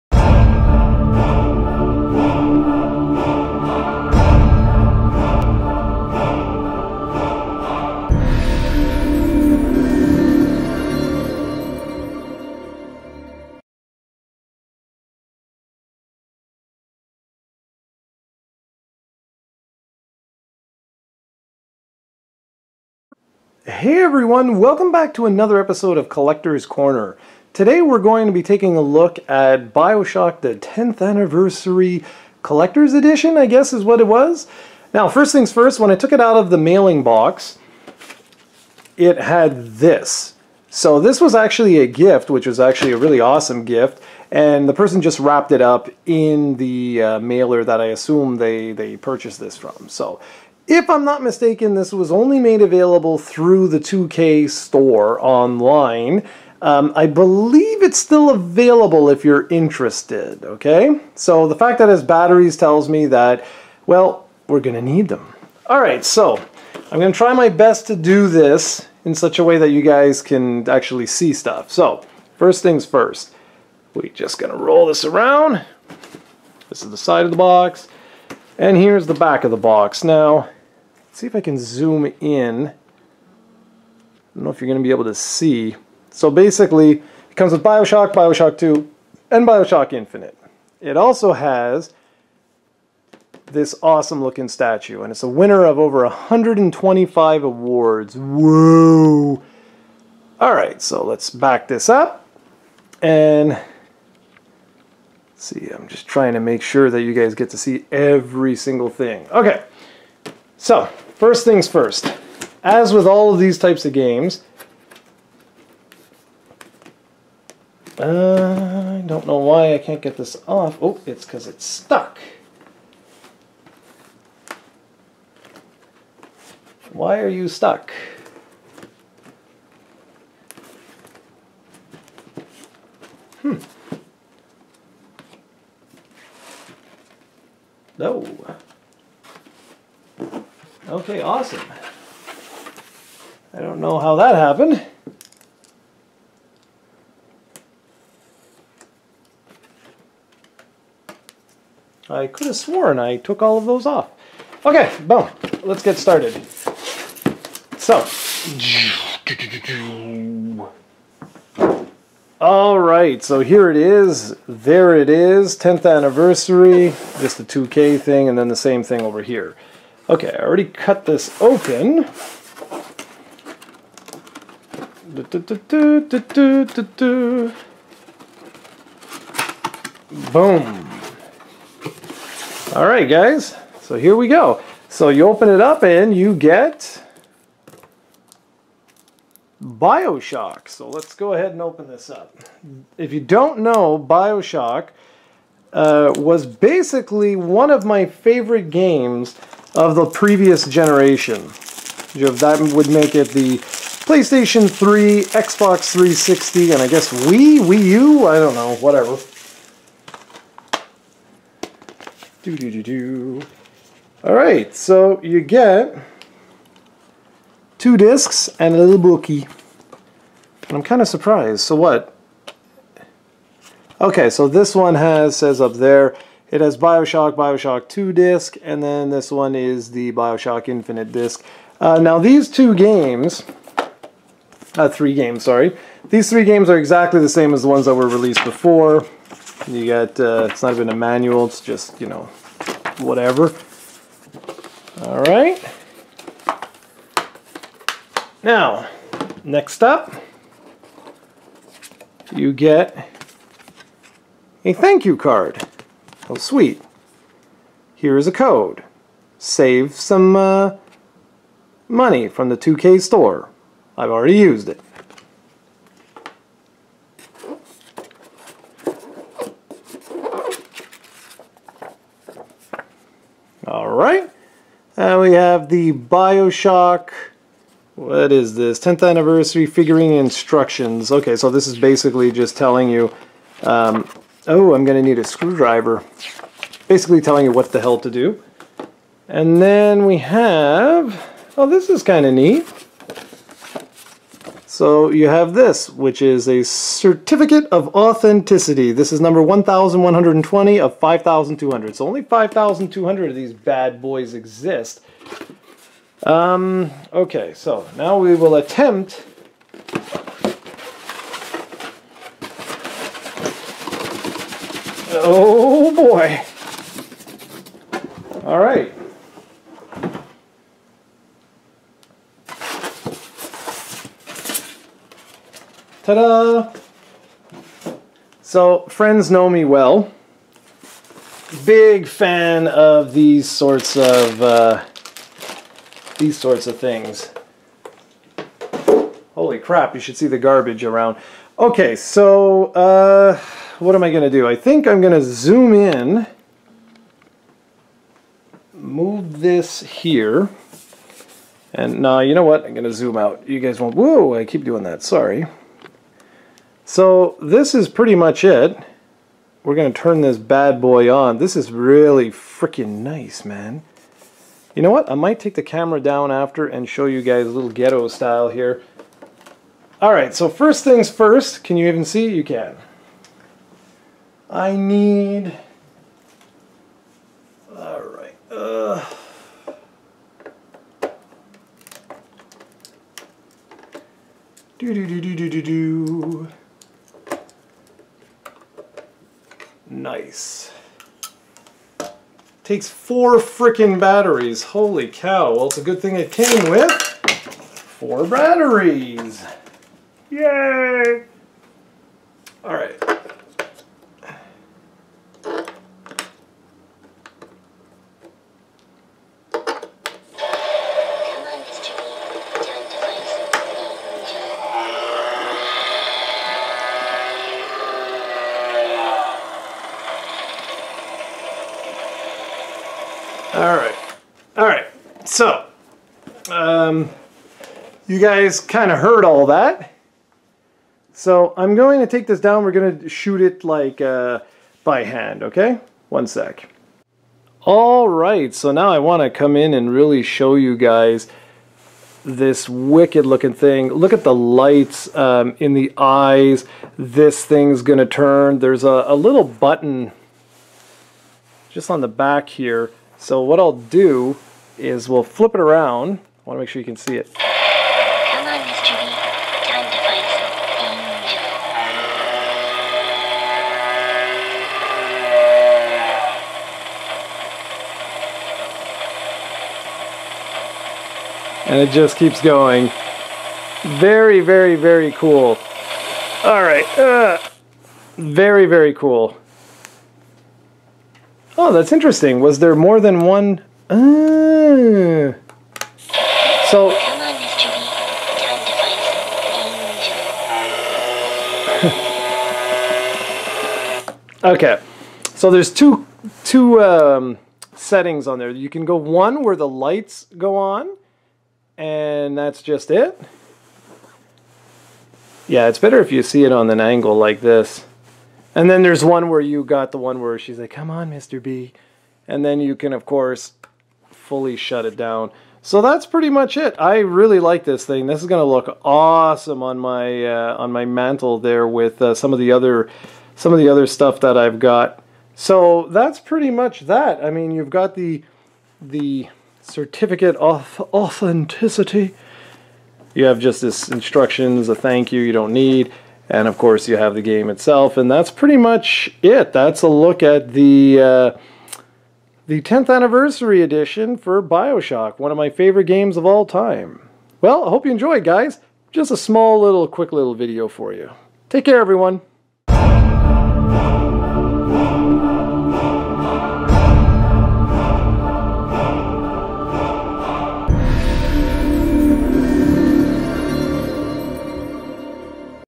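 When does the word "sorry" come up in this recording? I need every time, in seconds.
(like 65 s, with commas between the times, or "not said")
235 s, 355 s.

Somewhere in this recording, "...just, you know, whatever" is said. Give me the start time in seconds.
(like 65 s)
241 s.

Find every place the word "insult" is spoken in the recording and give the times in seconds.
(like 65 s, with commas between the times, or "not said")
not said.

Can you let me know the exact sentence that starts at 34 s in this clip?
Now first things first, when I took it out of the mailing box, it had this.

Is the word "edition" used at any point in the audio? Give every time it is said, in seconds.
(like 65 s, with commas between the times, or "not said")
32 s, 543 s.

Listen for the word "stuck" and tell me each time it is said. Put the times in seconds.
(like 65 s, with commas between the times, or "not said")
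121 s, 127 s.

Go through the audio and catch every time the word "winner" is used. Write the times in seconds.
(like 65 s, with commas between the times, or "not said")
95 s.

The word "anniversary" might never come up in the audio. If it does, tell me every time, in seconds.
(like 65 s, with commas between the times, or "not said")
31 s, 165 s, 279 s, 542 s.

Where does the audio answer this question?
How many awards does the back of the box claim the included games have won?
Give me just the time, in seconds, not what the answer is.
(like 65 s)
95 s.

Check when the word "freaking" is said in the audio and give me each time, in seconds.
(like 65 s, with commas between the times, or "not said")
362 s.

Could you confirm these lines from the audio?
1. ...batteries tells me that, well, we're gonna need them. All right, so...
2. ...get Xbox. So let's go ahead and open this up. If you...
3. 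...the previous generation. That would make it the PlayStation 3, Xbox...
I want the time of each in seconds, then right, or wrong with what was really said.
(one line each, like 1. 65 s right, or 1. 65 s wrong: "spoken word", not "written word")
1. 62 s right
2. 186 s wrong: "Bioshock", not "Xbox"
3. 199 s right.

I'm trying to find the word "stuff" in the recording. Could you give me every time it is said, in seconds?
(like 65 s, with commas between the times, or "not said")
71 s, 523 s.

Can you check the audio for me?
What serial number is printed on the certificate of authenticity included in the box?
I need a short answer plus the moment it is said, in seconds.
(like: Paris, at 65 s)
1,120, at 299 s.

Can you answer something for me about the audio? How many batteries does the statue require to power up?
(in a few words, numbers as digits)
4.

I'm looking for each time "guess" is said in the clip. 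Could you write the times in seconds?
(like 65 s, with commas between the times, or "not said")
33 s, 206 s.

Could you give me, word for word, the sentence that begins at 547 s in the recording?
Well, I hope you enjoyed, guys.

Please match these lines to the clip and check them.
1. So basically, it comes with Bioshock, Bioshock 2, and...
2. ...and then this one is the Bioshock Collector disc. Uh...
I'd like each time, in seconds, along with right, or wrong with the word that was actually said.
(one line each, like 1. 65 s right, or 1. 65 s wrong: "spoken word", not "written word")
1. 86 s right
2. 228 s wrong: "Infinite", not "Collector".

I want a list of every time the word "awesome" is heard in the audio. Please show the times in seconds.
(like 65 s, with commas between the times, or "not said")
43 s, 93 s, 141 s, 518 s.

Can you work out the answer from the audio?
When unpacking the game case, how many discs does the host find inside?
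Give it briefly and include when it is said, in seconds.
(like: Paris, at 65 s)
2, at 217 s.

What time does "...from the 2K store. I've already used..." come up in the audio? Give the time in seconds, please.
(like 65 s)
262 s.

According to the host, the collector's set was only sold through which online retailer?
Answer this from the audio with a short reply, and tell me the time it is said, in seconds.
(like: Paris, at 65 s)
2K store, at 53 s.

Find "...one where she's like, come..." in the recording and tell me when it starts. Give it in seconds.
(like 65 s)
509 s.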